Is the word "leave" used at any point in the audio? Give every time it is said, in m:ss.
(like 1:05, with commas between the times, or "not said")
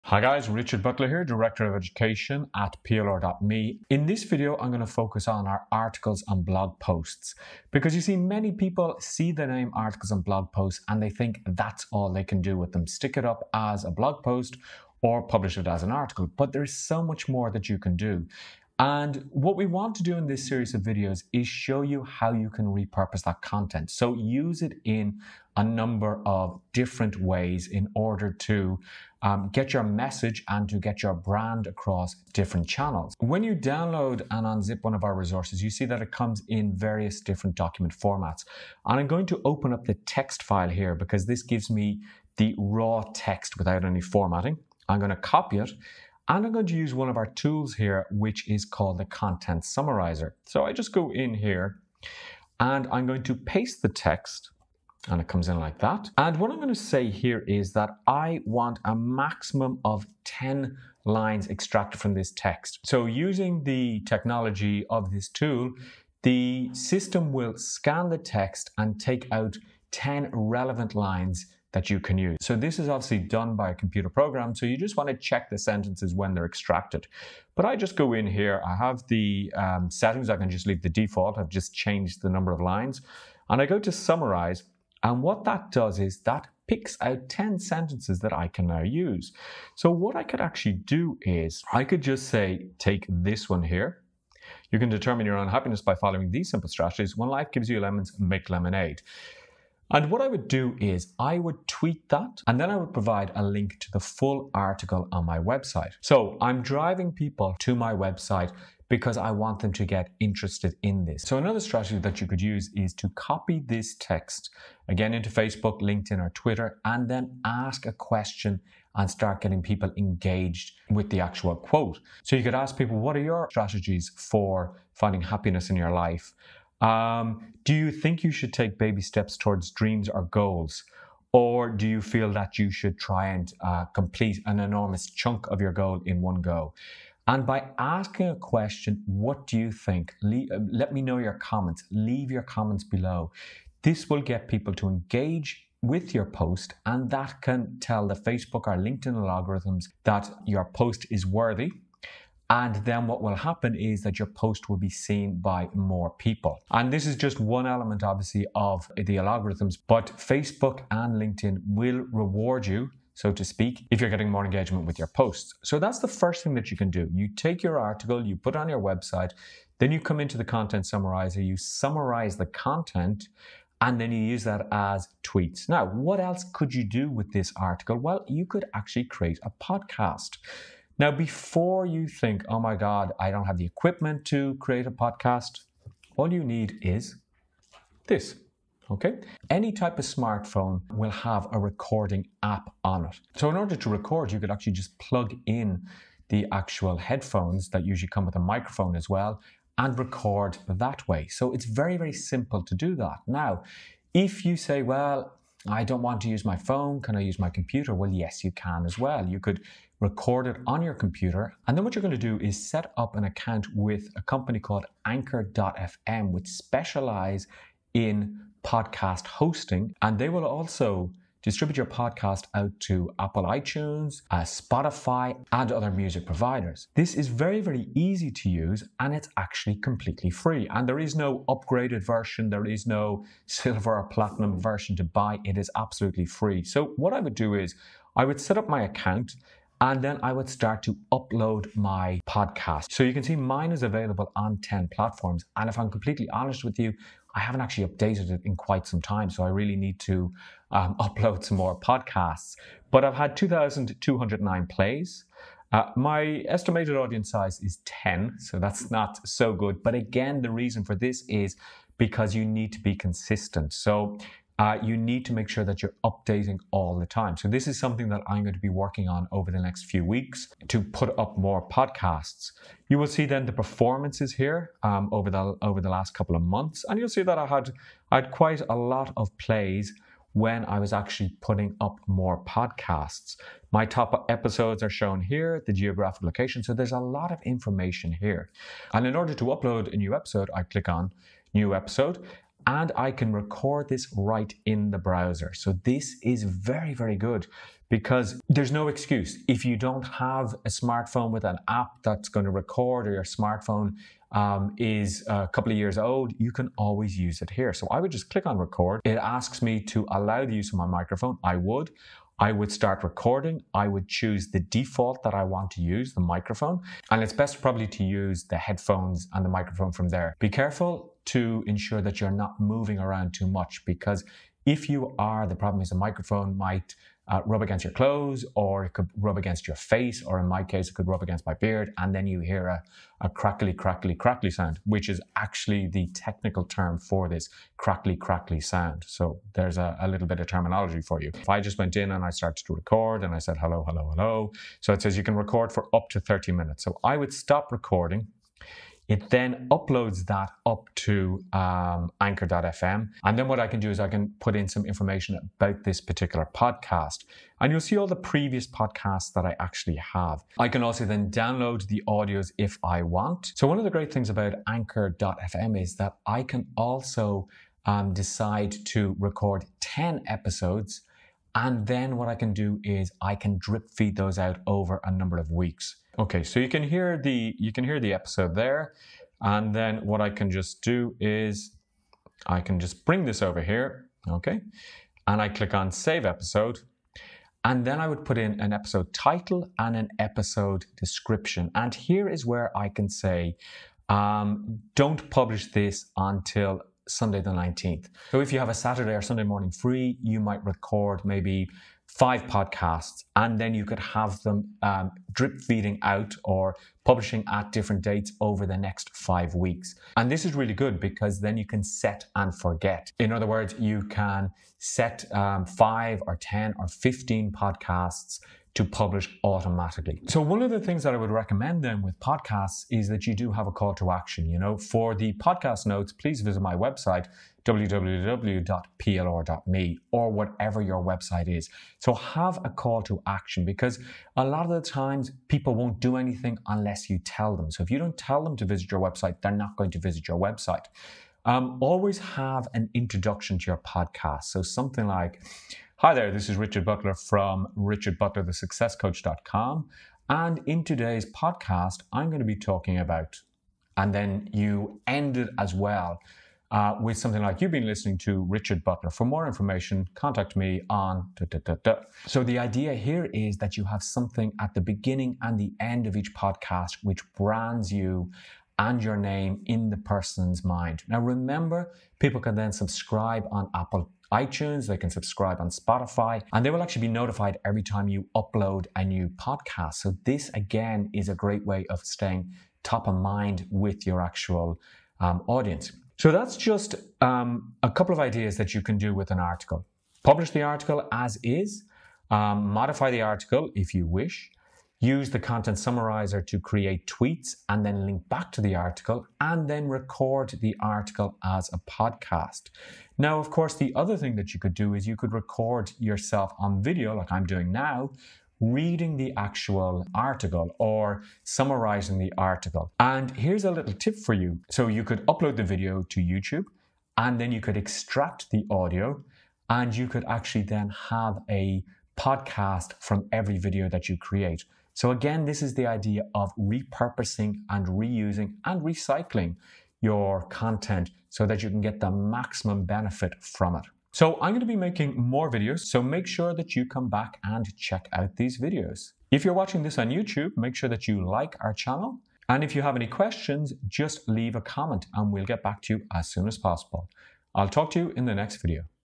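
1:20, 2:21, 9:04.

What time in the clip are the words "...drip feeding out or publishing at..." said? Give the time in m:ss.
6:45.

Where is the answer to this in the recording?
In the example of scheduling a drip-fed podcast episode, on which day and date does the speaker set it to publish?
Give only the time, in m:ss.
6:37.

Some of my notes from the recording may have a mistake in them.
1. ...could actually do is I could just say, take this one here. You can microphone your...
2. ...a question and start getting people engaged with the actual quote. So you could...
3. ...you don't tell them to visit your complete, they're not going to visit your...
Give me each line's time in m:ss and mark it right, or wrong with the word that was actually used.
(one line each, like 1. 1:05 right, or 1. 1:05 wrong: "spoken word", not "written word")
1. 1:30 wrong: "determine", not "microphone"
2. 1:57 right
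3. 7:17 wrong: "website", not "complete".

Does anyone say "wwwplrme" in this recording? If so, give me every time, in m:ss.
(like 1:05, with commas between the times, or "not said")
7:07.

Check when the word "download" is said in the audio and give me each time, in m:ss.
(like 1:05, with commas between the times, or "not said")
0:33, 6:01.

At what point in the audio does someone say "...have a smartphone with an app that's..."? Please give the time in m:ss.
5:00.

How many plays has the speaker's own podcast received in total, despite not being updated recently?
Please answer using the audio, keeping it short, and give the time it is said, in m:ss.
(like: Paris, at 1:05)
2,209, at 4:13.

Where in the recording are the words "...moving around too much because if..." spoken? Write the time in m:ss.
5:22.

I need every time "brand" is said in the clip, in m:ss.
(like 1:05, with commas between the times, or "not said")
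0:31, 7:47.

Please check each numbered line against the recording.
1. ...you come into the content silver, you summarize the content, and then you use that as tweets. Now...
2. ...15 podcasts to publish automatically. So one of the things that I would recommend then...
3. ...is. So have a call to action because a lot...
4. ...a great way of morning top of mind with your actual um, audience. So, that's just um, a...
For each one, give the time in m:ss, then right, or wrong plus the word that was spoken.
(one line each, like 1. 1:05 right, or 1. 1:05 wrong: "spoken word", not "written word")
1. 2:49 wrong: "summarizer", not "silver"
2. 6:56 right
3. 7:11 right
4. 8:01 wrong: "staying", not "morning".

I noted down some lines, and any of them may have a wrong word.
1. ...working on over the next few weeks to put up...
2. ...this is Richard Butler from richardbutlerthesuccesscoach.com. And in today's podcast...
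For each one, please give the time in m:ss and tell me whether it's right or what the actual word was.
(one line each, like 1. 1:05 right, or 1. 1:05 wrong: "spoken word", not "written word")
1. 4:28 right
2. 7:26 right.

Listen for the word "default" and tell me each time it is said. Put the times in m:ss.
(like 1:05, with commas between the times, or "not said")
1:20, 5:14.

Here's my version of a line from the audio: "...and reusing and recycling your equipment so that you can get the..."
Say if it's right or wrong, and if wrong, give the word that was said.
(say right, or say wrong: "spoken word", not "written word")
wrong: "content", not "equipment".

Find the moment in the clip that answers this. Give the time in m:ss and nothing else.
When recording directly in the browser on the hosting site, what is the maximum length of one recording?
5:46.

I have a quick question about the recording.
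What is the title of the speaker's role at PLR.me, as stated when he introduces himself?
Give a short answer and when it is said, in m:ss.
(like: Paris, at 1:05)
Director of Education, at 0:01.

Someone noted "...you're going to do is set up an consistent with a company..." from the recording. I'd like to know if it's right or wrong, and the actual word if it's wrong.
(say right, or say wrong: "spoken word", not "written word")
wrong: "account", not "consistent".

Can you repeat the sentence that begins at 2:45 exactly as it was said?
So that's the first thing that you can do.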